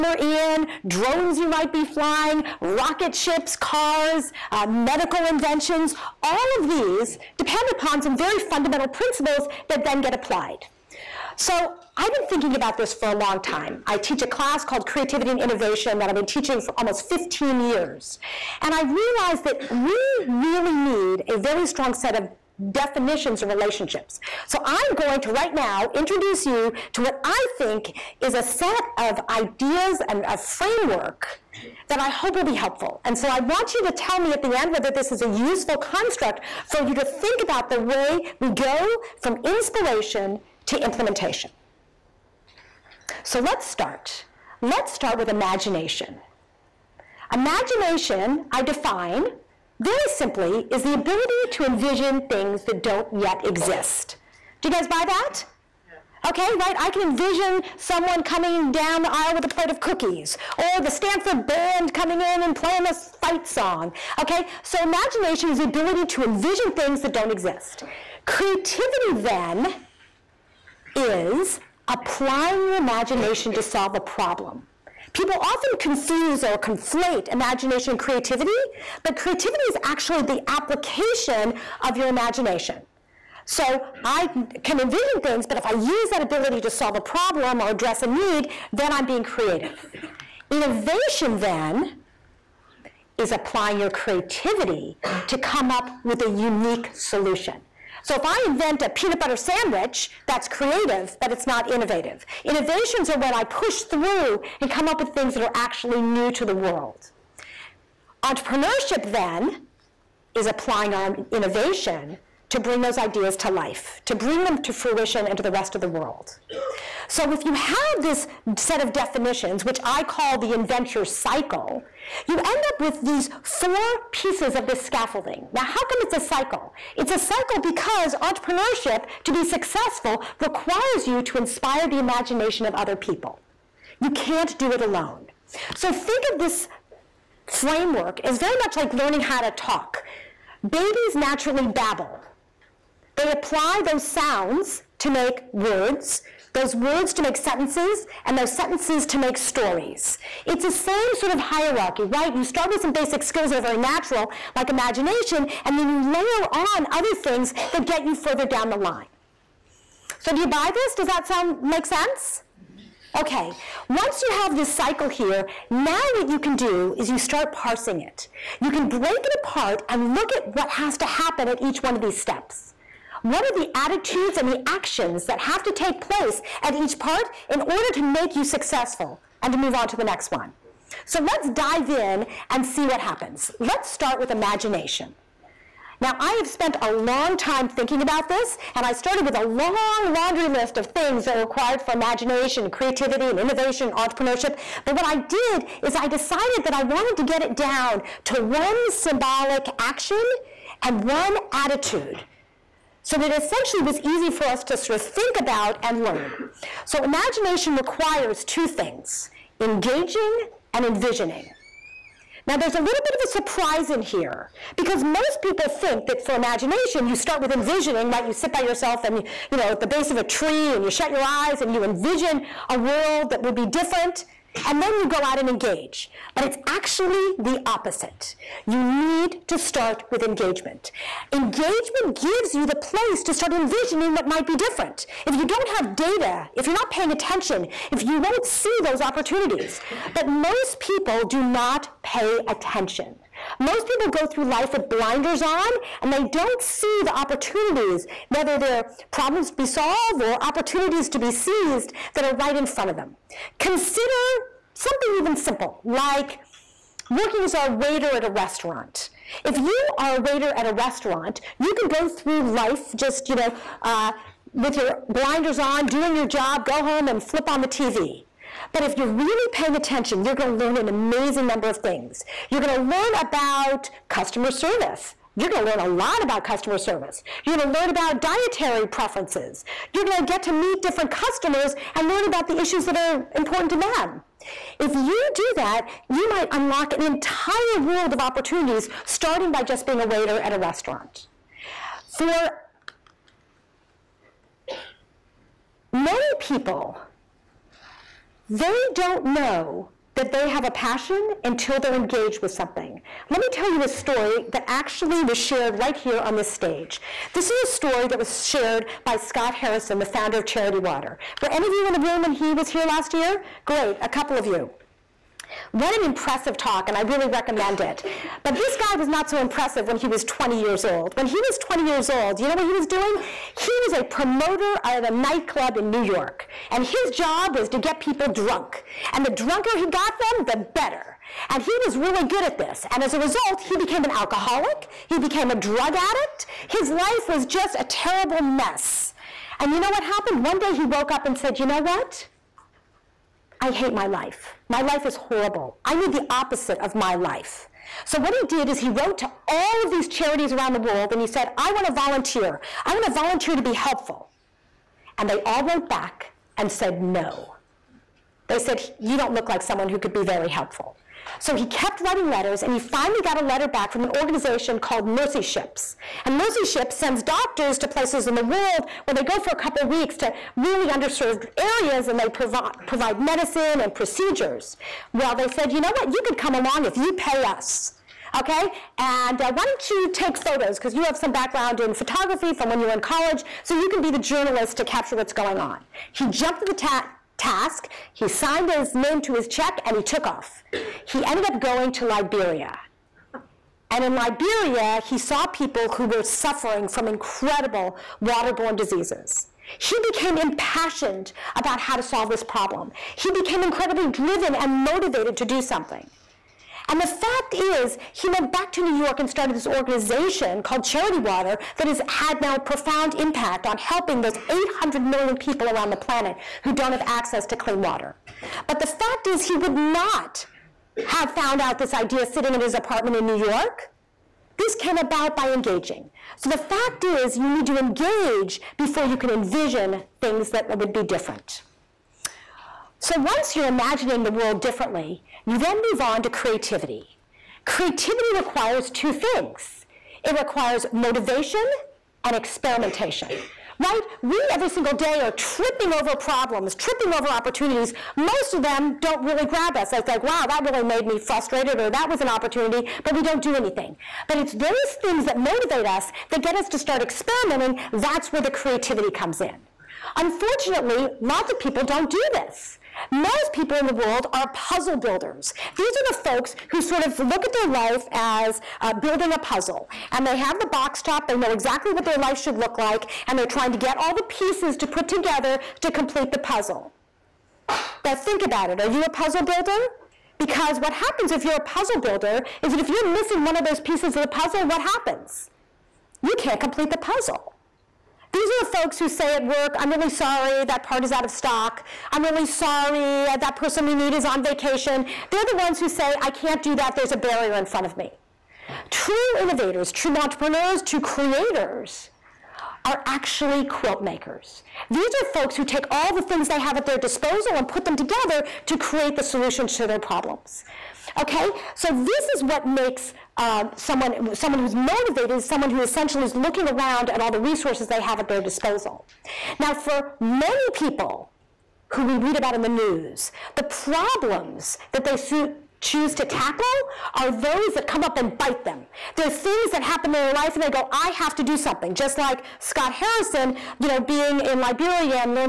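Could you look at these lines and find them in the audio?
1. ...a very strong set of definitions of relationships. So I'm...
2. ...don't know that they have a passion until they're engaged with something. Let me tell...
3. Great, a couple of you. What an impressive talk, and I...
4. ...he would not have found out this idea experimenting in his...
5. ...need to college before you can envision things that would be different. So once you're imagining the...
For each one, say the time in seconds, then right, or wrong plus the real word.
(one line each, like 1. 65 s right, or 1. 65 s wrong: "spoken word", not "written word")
1. 21 s right
2. 298 s right
3. 313 s right
4. 419 s wrong: "sitting", not "experimenting"
5. 427 s wrong: "engage", not "college".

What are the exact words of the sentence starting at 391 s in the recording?
He ended up going to Liberia.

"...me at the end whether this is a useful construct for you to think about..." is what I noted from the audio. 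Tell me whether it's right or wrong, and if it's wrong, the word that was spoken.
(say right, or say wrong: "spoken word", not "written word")
right.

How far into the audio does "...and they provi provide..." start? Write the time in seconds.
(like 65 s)
372 s.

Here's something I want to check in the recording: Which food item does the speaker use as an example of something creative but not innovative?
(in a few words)
peanut butter sandwich.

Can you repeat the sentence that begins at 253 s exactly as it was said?
Consider something even simple, like working as a waiter at a restaurant.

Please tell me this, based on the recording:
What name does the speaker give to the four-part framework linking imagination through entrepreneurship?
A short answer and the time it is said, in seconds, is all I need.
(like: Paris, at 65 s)
the invention cycle, at 120 s.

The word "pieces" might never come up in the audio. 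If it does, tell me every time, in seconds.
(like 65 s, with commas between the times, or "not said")
124 s, 474 s, 483 s.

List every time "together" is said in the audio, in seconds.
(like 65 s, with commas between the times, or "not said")
475 s, 507 s.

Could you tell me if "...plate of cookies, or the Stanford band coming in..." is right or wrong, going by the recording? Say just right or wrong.
right.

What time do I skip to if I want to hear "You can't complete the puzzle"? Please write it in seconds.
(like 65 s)
486 s.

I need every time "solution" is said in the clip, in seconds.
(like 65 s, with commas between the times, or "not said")
96 s, 509 s.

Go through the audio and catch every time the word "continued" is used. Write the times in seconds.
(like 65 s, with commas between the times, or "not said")
not said.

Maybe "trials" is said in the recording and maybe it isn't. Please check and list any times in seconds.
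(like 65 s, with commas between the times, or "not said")
not said.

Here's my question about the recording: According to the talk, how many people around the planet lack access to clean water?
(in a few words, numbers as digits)
800 million.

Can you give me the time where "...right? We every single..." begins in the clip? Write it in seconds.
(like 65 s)
443 s.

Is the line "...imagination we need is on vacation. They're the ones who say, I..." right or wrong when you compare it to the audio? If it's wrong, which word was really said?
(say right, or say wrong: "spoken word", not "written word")
wrong: "person", not "imagination".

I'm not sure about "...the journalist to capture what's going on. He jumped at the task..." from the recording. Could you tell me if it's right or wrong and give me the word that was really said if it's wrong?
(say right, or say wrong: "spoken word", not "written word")
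right.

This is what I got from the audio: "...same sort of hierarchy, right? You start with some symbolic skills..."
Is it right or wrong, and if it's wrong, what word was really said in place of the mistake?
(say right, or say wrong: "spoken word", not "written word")
wrong: "basic", not "symbolic".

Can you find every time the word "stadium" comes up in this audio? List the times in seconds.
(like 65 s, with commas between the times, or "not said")
not said.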